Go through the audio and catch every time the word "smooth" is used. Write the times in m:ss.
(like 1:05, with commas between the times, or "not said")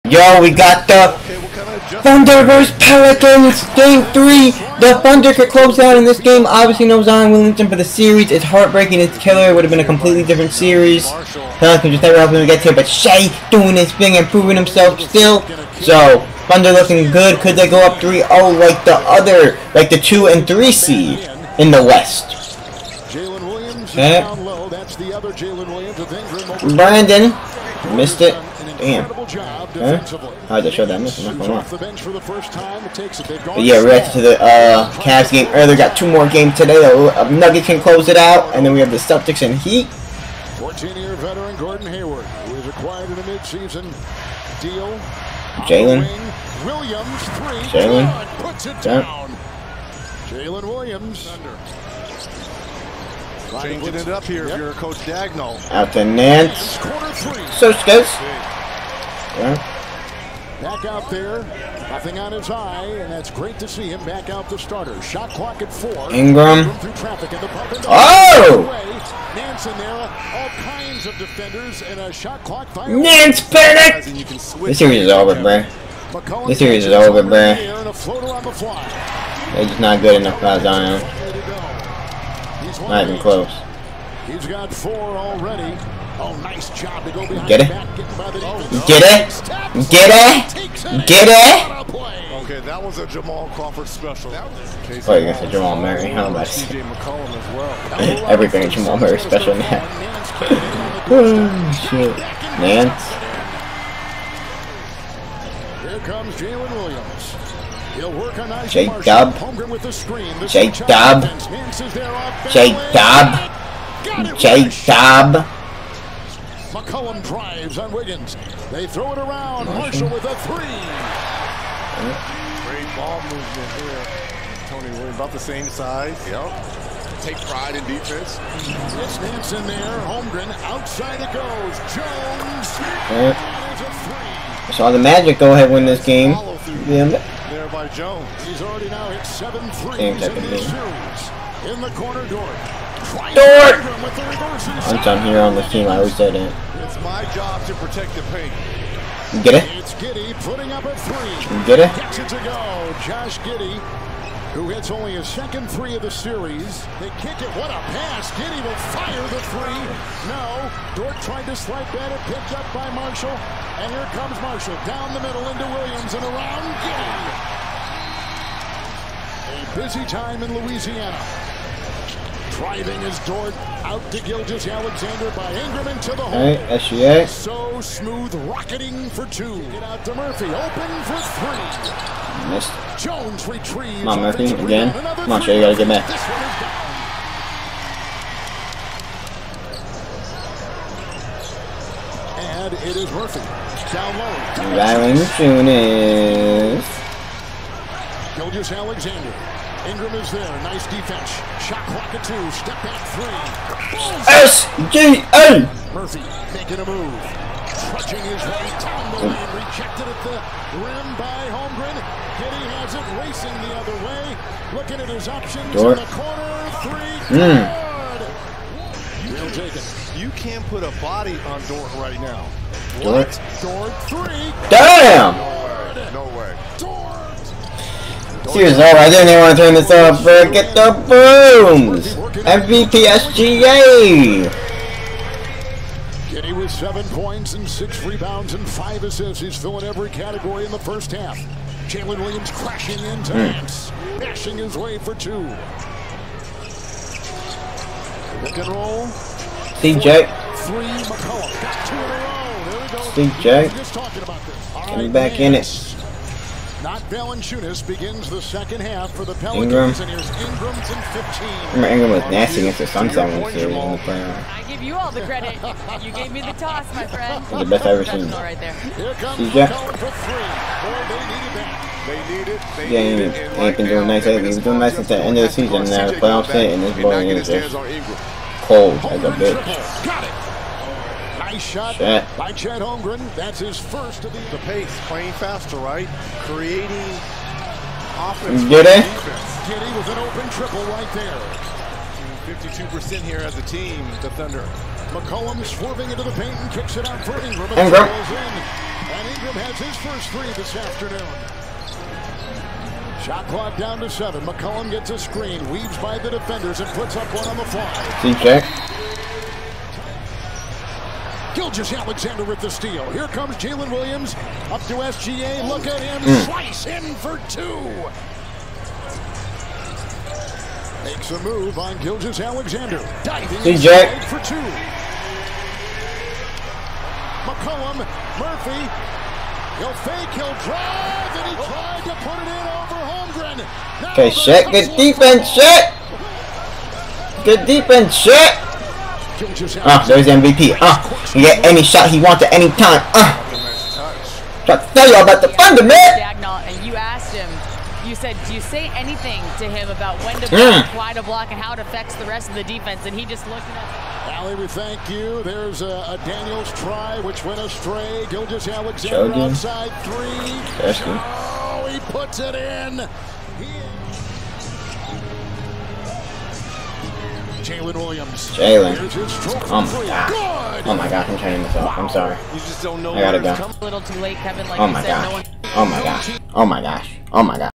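2:57.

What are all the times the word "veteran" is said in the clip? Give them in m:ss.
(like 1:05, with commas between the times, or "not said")
0:41.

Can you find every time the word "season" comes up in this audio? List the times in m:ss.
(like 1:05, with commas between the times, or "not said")
0:43, 4:35.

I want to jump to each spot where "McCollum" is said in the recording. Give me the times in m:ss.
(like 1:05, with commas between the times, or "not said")
1:56, 4:11, 4:55, 5:04, 5:27.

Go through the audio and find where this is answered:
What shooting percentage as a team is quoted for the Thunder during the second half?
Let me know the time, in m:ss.
4:52.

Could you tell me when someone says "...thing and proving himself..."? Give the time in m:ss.
0:13.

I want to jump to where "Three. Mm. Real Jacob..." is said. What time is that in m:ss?
3:36.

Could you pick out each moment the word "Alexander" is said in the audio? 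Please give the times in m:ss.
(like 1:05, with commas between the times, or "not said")
2:54, 3:18, 5:11, 5:21, 5:58.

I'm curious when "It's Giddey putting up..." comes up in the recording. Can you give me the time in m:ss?
2:29.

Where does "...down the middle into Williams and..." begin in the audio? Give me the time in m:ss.
2:44.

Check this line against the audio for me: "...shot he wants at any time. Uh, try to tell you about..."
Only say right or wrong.
right.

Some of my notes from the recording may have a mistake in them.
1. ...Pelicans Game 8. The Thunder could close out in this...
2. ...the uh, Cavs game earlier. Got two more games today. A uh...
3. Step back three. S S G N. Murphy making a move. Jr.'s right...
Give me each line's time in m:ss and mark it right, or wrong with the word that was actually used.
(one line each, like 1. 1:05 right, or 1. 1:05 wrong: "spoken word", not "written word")
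1. 0:02 wrong: "3", not "8"
2. 0:34 right
3. 3:22 right.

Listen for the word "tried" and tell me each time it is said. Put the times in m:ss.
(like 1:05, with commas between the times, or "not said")
2:41, 5:31.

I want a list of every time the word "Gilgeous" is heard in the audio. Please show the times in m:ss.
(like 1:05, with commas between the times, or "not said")
2:54, 3:18, 5:11, 5:21, 5:58.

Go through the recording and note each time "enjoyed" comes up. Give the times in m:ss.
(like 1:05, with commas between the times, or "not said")
not said.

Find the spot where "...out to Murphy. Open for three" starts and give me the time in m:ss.
2:59.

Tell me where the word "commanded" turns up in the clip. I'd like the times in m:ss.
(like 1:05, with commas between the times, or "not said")
not said.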